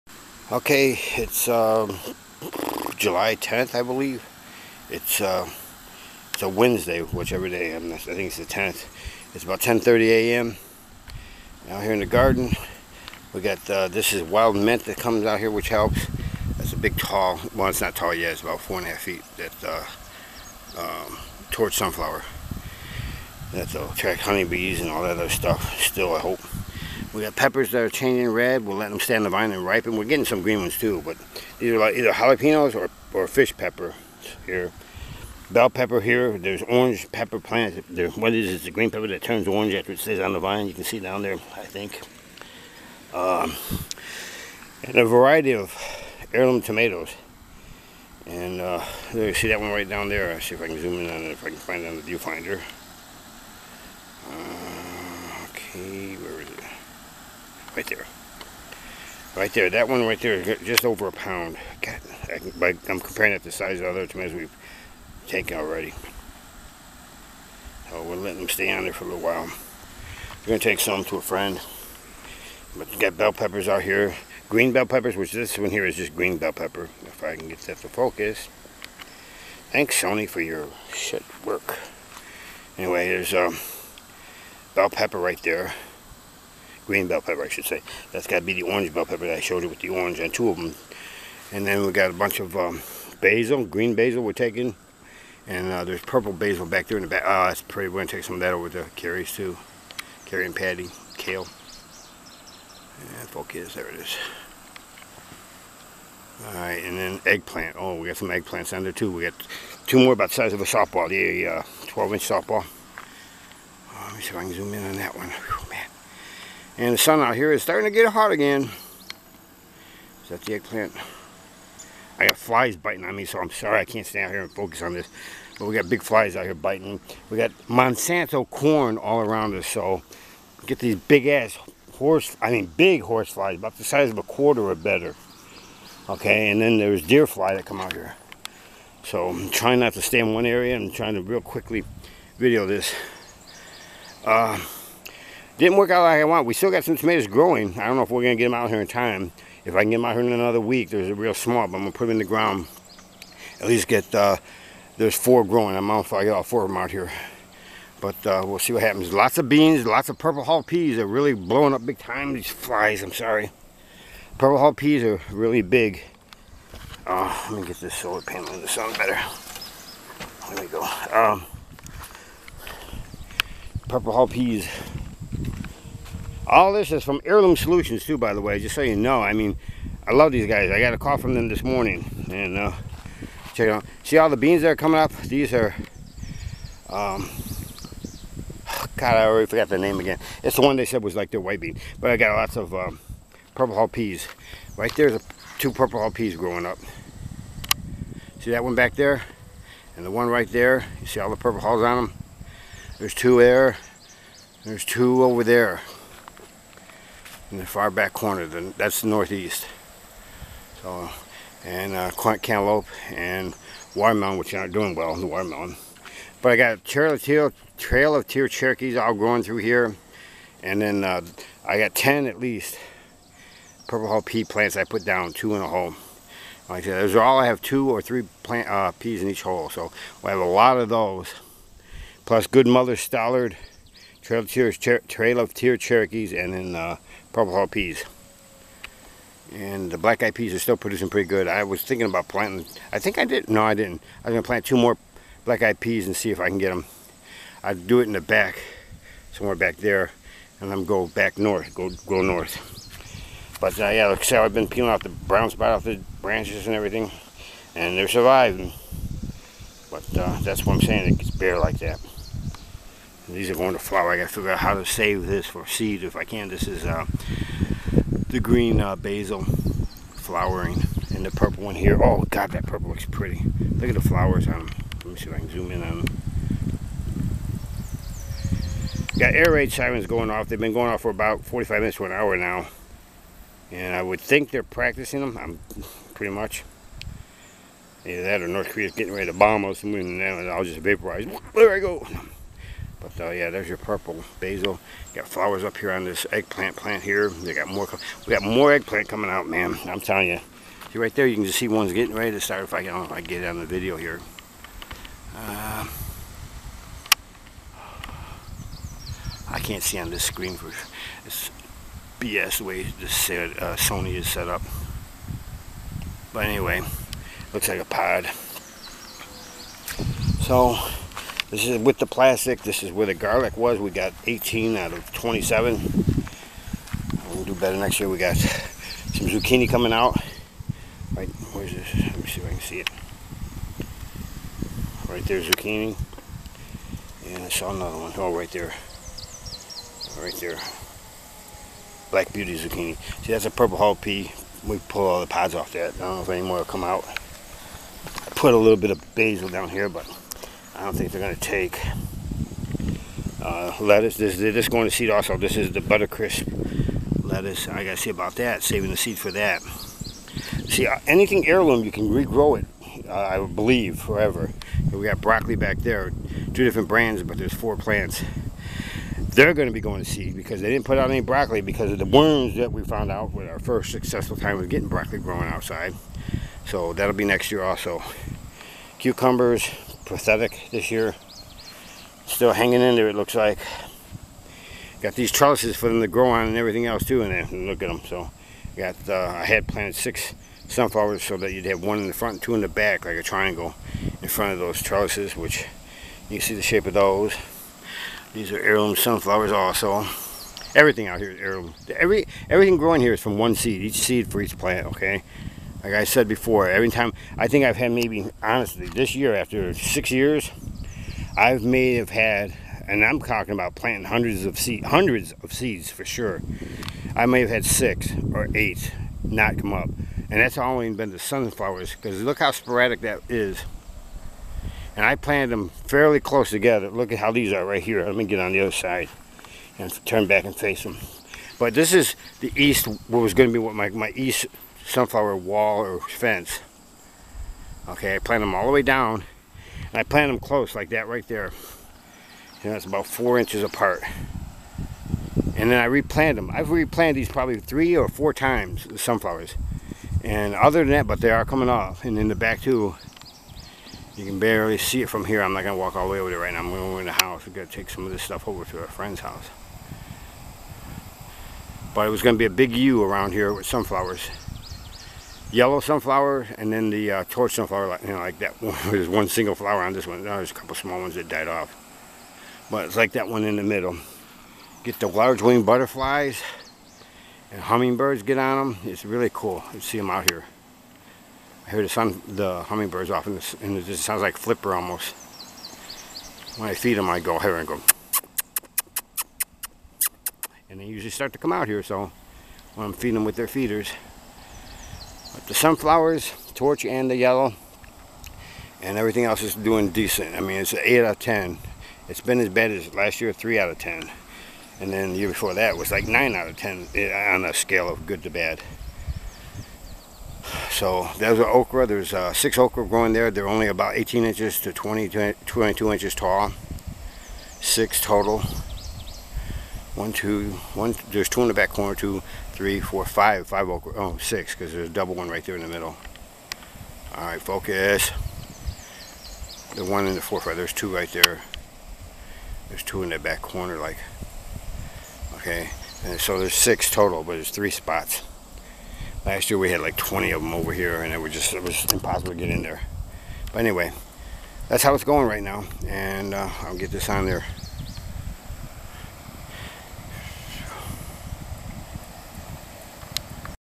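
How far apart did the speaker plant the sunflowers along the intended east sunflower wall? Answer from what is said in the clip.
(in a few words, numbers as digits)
About 4 inches.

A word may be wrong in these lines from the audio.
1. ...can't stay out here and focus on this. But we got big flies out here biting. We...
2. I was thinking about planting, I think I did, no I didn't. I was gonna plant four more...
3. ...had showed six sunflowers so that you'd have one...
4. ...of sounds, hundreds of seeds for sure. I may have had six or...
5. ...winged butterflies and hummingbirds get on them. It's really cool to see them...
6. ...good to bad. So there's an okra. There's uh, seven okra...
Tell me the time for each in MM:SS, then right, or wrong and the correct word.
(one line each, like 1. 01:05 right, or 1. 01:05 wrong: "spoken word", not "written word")
1. 02:03 right
2. 04:01 wrong: "two", not "four"
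3. 06:29 wrong: "planted", not "showed"
4. 06:54 wrong: "seeds", not "sounds"
5. 07:55 right
6. 08:28 wrong: "six", not "seven".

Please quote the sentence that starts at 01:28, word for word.
That's got to be the orange bell pepper that I showed you with the orange and two of them.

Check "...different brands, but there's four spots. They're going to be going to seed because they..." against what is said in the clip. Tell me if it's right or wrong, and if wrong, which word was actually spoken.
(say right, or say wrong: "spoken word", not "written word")
wrong: "plants", not "spots".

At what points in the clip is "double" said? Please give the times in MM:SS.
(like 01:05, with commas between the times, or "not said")
08:44.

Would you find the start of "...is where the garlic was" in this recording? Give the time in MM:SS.
05:22.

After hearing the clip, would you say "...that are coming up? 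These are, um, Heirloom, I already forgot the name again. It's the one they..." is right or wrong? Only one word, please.
wrong.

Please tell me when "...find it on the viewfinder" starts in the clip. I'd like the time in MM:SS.
00:51.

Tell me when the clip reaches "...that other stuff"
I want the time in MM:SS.
00:25.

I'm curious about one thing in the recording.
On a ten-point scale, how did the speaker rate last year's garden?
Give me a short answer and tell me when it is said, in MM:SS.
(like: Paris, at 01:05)
3 out of 10, at 08:23.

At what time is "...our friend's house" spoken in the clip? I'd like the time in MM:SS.
07:38.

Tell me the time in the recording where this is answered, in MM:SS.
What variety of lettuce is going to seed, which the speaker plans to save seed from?
05:55.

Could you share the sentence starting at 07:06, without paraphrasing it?
Look at how these are right here.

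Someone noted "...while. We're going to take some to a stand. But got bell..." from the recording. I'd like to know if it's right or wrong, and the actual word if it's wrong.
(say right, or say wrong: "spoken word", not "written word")
wrong: "friend", not "stand".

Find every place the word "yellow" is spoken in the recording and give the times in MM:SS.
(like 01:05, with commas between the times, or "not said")
07:45, 08:17.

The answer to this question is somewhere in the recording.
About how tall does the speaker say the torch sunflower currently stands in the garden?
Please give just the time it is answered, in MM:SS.
00:18.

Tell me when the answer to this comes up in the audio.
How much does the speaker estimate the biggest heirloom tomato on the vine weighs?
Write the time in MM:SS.
01:00.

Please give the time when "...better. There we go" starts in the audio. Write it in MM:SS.
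02:48.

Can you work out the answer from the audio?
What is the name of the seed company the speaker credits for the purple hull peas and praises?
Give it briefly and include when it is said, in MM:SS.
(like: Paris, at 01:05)
Heirloom Solutions, at 02:57.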